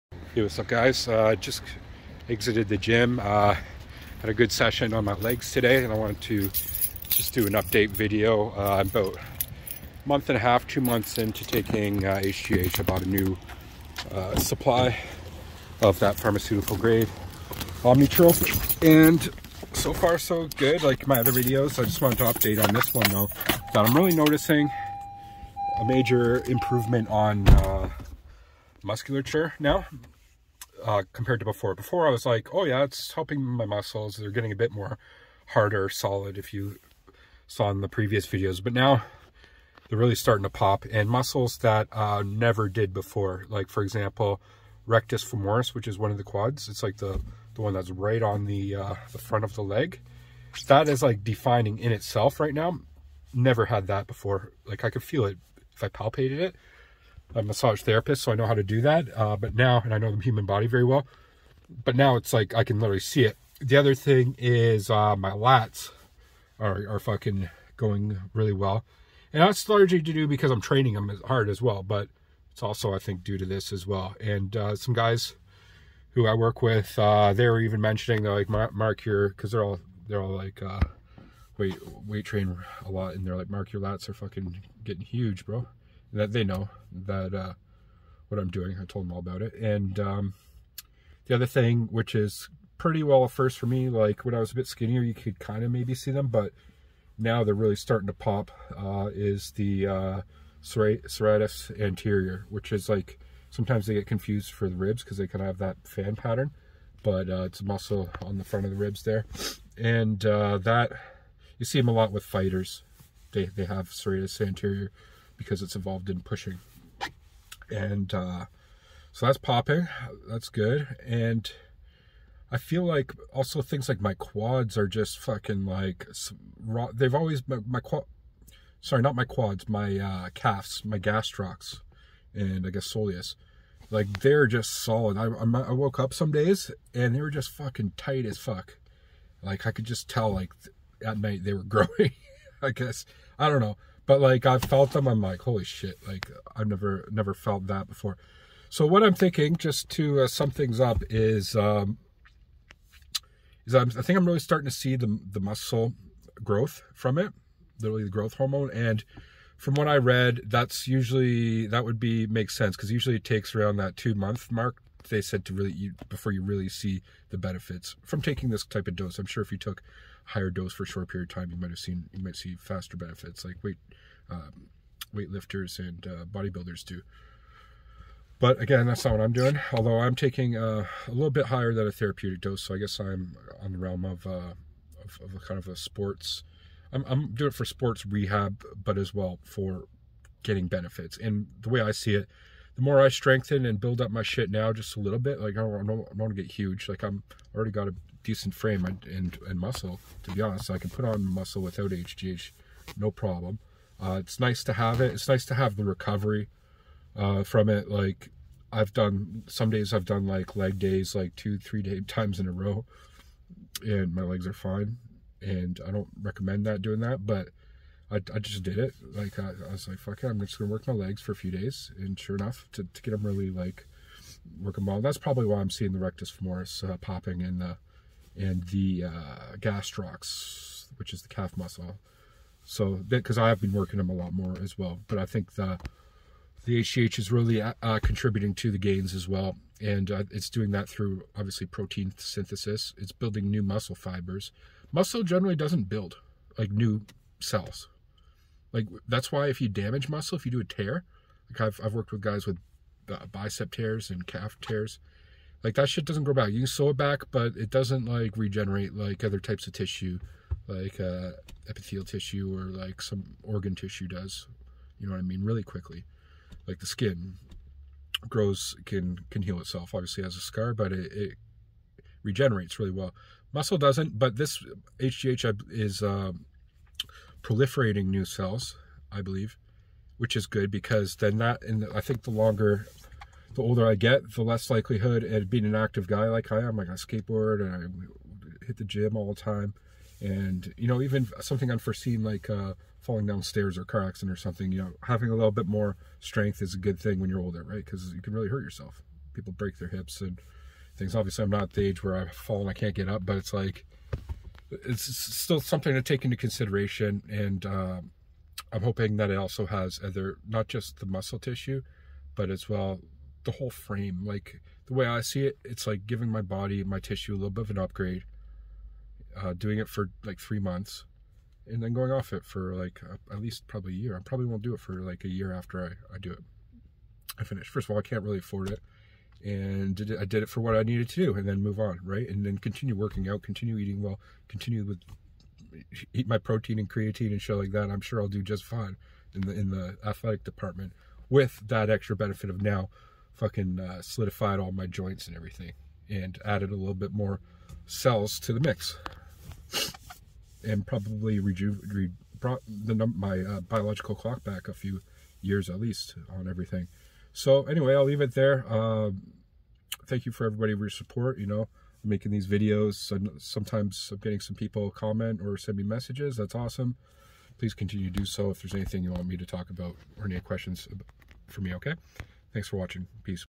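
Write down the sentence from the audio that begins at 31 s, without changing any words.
Before I was like, oh yeah, it's helping my muscles.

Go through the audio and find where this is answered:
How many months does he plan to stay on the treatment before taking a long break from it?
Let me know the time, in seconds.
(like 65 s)
320 s.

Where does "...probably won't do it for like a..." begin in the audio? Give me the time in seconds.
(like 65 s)
324 s.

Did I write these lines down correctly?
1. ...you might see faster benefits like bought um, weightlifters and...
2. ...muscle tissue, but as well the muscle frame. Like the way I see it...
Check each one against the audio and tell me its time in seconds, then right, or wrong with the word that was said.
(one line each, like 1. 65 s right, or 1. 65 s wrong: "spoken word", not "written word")
1. 172 s wrong: "weight", not "bought"
2. 311 s wrong: "whole", not "muscle".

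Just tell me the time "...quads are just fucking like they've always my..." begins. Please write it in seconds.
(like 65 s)
124 s.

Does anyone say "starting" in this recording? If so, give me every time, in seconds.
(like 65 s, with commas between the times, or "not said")
40 s, 97 s, 154 s.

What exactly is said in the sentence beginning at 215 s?
And I don't recommend that doing that, but I, I just did it.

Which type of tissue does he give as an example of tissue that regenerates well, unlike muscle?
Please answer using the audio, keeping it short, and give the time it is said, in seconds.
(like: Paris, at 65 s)
epithelial tissue, at 261 s.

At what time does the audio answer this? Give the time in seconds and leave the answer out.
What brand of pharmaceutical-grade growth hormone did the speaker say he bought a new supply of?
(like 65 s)
17 s.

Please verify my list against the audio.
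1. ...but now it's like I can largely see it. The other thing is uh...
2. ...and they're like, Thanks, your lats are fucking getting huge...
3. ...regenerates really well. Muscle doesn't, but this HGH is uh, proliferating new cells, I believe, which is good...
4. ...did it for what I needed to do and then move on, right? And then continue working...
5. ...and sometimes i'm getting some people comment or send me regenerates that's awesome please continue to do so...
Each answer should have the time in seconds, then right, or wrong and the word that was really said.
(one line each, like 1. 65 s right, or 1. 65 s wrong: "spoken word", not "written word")
1. 61 s wrong: "literally", not "largely"
2. 83 s wrong: "Mark", not "Thanks"
3. 272 s right
4. 330 s right
5. 363 s wrong: "messages", not "regenerates".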